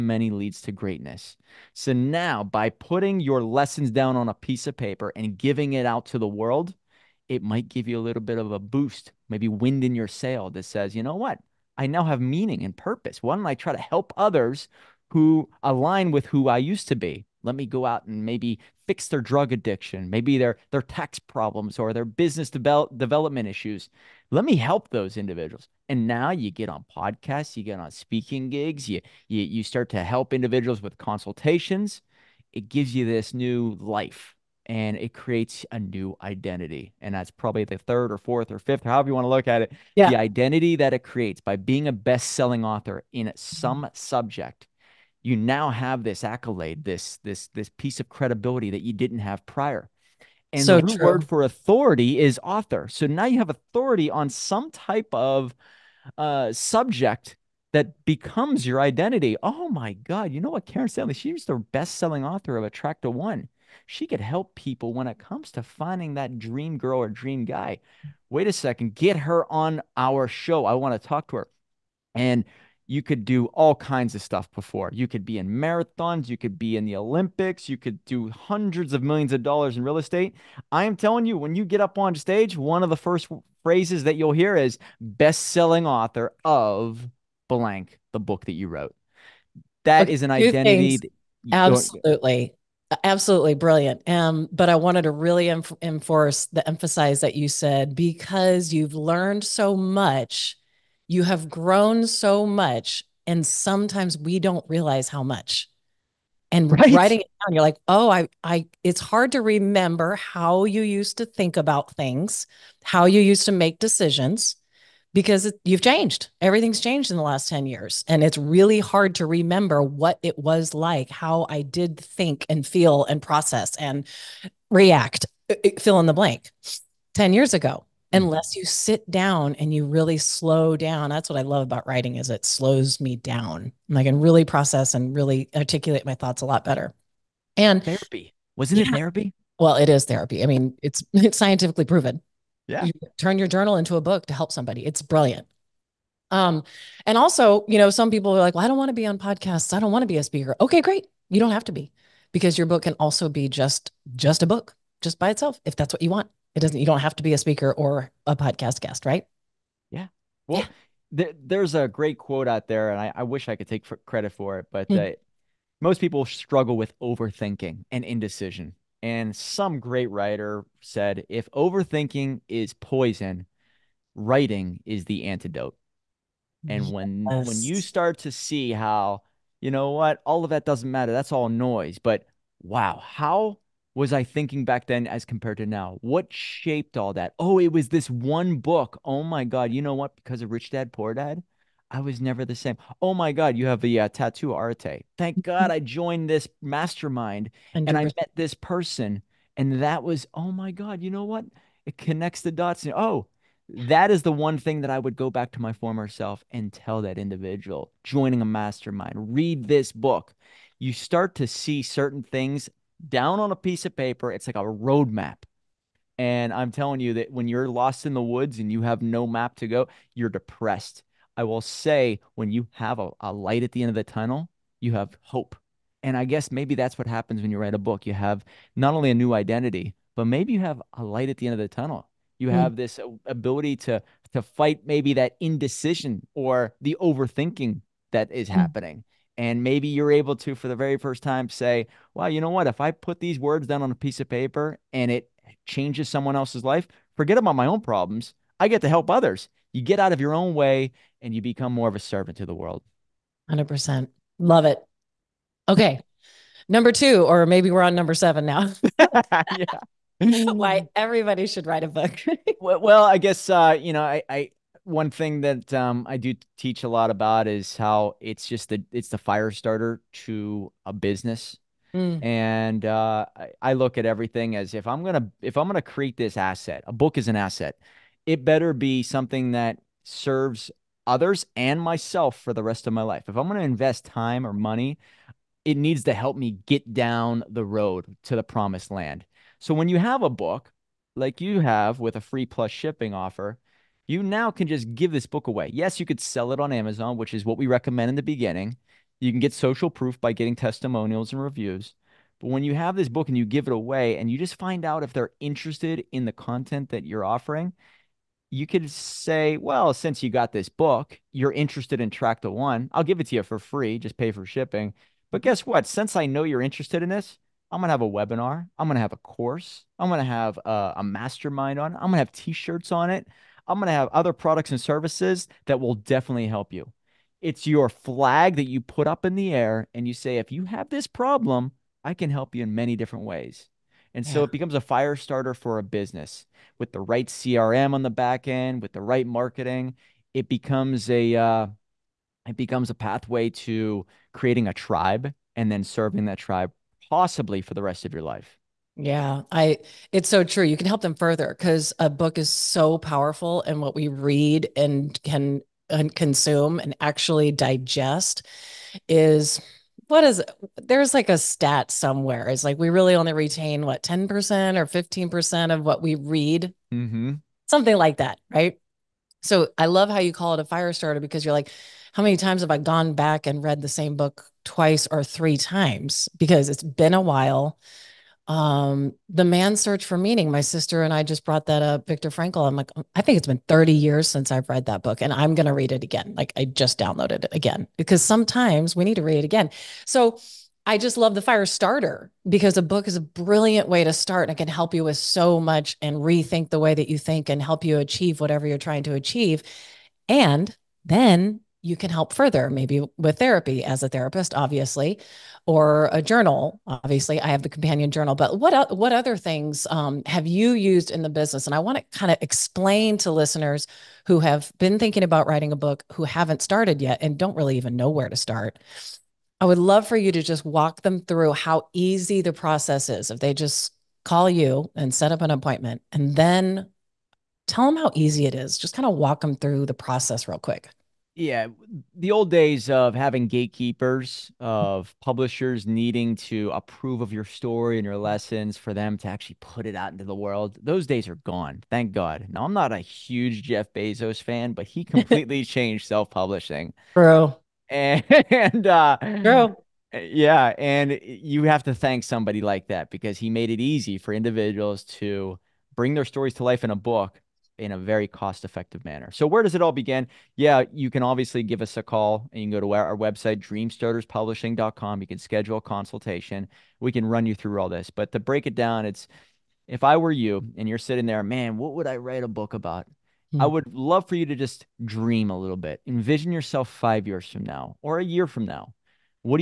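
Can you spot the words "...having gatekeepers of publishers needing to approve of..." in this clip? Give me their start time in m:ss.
7:13.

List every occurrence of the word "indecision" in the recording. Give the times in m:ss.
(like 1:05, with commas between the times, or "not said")
2:48, 3:55.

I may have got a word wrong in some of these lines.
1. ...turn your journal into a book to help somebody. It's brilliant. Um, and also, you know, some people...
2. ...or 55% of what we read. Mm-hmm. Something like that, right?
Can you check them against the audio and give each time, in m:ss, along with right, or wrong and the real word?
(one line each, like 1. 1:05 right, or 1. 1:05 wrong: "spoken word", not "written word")
1. 2:23 right
2. 6:04 wrong: "15", not "55".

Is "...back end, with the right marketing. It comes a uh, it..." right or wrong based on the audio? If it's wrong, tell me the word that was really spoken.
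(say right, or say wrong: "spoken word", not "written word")
wrong: "becomes", not "comes".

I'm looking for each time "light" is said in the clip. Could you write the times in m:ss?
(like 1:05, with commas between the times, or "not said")
3:43, 3:51.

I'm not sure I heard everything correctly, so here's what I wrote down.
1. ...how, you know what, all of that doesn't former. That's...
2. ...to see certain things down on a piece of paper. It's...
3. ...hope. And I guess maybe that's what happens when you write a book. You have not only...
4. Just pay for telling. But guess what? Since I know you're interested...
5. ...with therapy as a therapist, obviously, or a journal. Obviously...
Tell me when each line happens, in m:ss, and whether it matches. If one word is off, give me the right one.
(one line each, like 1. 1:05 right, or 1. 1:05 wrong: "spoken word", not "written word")
1. 2:58 wrong: "matter", not "former"
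2. 3:31 right
3. 3:45 right
4. 5:13 wrong: "shipping", not "telling"
5. 6:43 right.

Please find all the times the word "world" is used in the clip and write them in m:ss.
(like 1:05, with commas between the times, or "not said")
0:06, 4:12, 7:20.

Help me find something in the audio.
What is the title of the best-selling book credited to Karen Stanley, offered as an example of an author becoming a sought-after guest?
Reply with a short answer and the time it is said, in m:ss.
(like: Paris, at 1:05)
Attract the One, at 1:02.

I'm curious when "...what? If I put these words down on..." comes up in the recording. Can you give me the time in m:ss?
4:02.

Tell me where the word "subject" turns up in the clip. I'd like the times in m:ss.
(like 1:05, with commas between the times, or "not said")
0:43, 0:56.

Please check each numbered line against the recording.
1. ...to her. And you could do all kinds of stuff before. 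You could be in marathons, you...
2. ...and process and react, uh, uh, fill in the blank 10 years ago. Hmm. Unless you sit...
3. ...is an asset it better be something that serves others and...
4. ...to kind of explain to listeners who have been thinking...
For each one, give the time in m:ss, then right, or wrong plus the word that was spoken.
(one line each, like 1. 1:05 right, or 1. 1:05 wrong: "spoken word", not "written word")
1. 1:11 right
2. 2:03 right
3. 4:37 right
4. 6:51 right.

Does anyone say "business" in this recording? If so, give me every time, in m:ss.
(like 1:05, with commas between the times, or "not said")
0:22, 4:30, 5:35, 6:51.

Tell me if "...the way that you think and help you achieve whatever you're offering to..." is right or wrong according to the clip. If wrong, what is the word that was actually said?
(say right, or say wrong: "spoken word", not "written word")
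wrong: "trying", not "offering".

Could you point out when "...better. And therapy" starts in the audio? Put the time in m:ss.
2:16.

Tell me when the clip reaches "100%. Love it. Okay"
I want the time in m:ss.
4:13.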